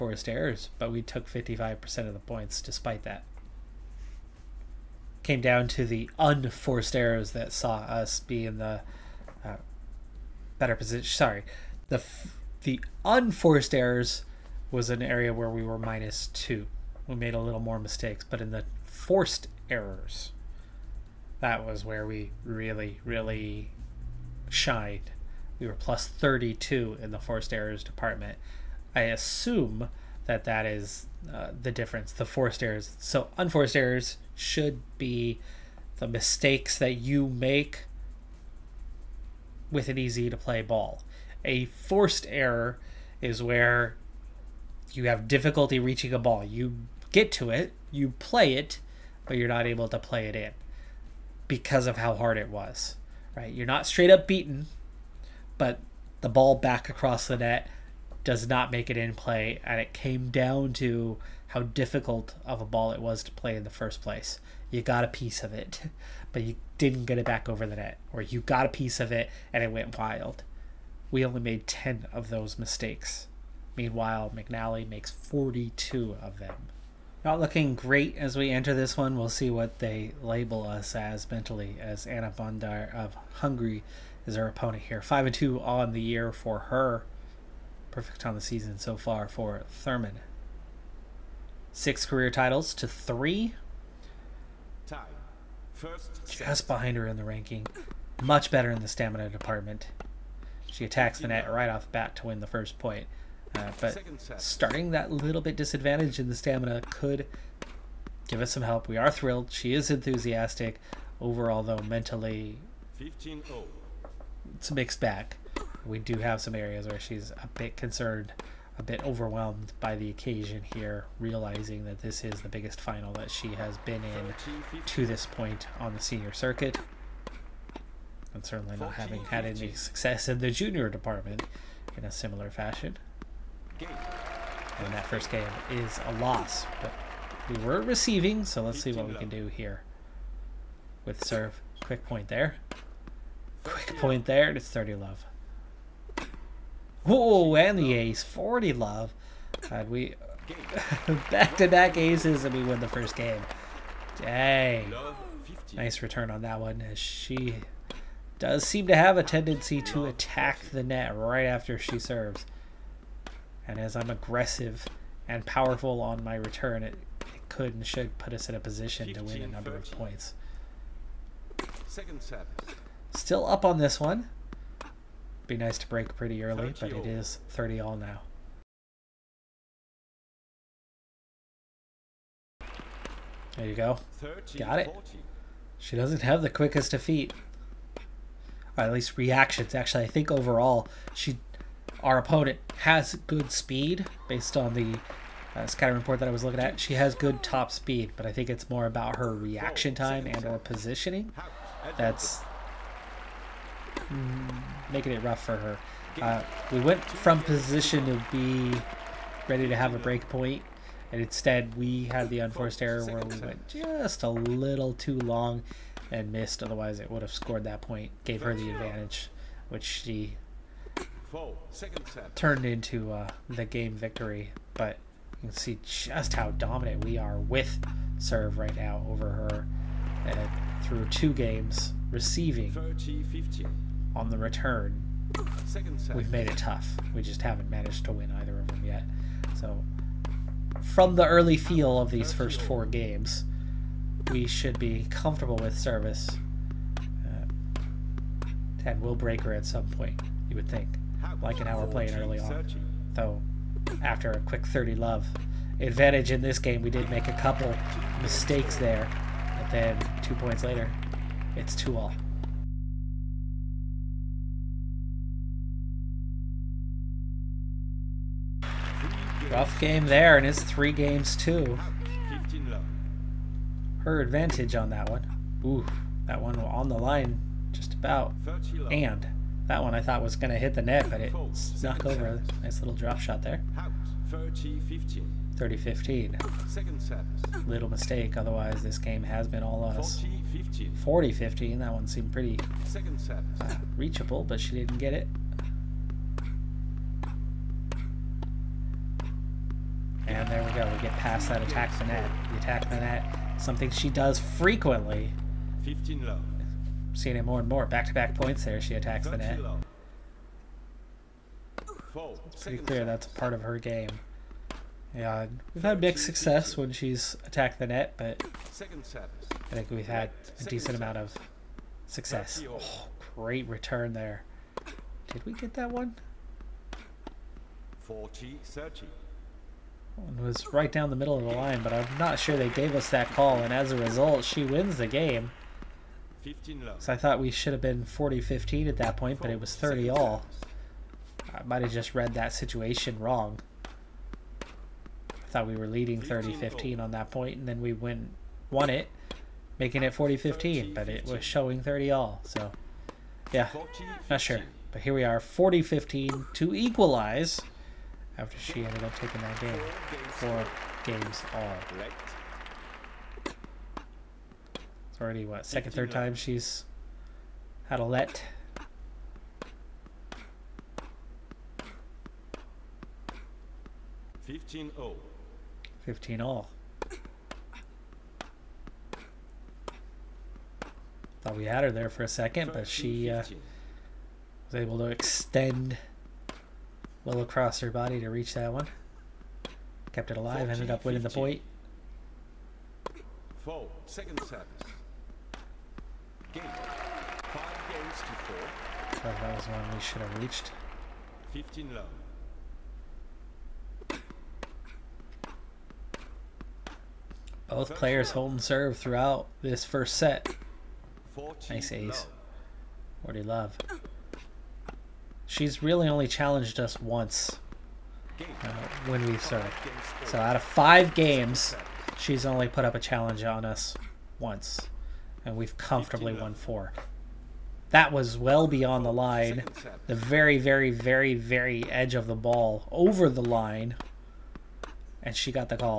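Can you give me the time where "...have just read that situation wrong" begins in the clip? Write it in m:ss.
5:41.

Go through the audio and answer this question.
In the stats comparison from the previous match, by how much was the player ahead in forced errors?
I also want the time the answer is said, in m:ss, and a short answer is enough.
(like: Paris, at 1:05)
+32, at 0:25.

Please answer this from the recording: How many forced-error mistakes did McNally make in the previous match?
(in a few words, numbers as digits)
42.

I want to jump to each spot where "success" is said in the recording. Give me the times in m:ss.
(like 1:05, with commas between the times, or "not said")
2:09, 5:16, 5:22.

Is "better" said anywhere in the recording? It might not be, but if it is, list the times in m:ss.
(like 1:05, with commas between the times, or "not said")
0:10, 1:38.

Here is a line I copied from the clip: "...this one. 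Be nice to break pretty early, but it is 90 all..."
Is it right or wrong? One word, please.
wrong.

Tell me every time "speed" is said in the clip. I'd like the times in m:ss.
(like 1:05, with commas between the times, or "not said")
3:13, 3:17.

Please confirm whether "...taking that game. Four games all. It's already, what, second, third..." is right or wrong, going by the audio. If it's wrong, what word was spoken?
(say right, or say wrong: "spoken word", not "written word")
right.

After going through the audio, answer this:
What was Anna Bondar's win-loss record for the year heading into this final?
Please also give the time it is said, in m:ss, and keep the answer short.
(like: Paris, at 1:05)
5 and 2, at 1:25.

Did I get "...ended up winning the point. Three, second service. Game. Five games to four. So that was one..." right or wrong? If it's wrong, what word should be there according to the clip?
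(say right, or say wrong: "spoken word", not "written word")
wrong: "Four", not "Three".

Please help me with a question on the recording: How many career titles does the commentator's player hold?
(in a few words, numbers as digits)
6.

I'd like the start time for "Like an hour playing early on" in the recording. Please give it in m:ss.
4:11.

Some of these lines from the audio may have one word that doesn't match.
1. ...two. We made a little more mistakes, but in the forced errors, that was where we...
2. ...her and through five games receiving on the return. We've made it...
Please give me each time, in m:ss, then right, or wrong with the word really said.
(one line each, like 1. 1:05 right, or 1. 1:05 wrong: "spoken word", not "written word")
1. 0:16 right
2. 3:49 wrong: "two", not "five".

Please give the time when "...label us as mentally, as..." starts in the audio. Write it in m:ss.
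1:20.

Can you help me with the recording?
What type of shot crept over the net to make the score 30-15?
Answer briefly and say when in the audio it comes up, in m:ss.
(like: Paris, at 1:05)
Drop shot, at 4:42.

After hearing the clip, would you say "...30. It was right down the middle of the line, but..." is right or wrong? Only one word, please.
right.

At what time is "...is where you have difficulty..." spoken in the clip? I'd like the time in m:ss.
0:43.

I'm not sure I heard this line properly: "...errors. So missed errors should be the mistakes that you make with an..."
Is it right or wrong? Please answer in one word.
wrong.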